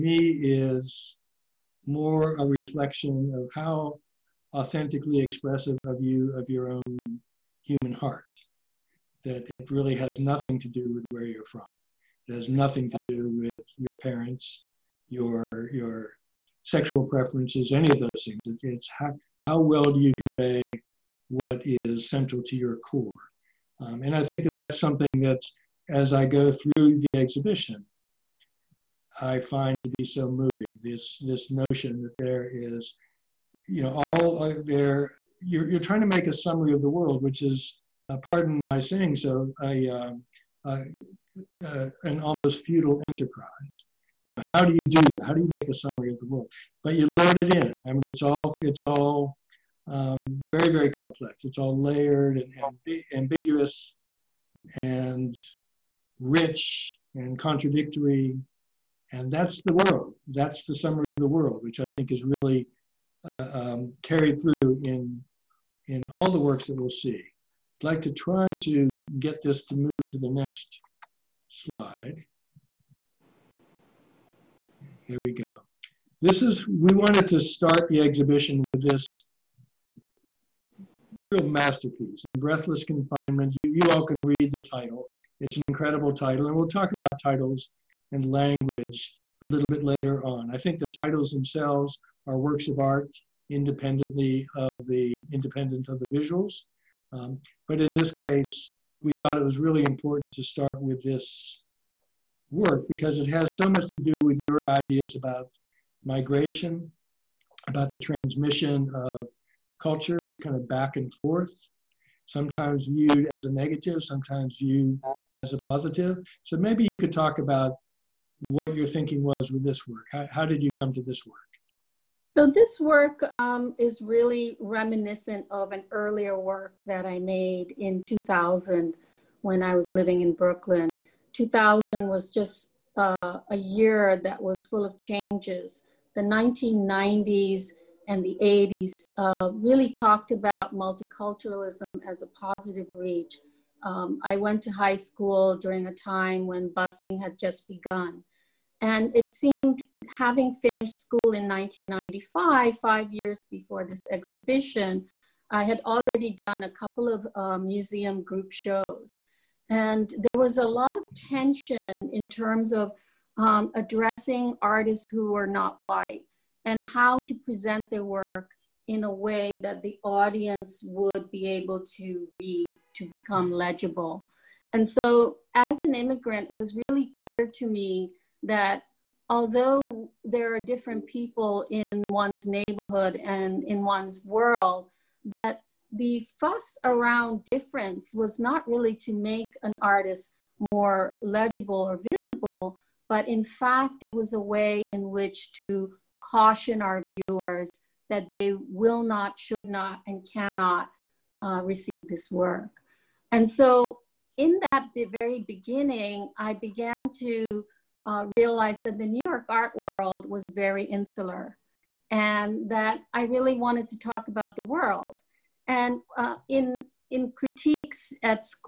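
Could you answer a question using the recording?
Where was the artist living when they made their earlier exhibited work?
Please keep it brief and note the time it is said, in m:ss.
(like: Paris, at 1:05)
Brooklyn, at 2:10.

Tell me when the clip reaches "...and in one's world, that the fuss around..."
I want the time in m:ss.
3:03.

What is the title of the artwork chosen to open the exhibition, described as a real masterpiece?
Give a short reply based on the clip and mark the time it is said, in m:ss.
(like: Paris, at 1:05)
In Breathless Confinement, at 1:22.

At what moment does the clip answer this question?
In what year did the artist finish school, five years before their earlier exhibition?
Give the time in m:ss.
2:31.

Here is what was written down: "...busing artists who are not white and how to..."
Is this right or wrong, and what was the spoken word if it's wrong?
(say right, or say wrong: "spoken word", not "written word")
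wrong: "addressing", not "busing".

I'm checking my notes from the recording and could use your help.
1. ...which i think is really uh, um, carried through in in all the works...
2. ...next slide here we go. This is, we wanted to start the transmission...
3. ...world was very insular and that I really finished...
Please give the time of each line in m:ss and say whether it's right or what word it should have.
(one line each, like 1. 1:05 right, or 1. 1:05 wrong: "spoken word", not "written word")
1. 1:01 right
2. 1:10 wrong: "exhibition", not "transmission"
3. 3:29 wrong: "wanted", not "finished".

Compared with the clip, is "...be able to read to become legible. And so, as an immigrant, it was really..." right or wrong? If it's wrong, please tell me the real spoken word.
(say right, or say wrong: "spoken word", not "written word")
right.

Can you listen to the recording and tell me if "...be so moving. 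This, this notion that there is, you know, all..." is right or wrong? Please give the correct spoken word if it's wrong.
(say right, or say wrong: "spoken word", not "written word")
right.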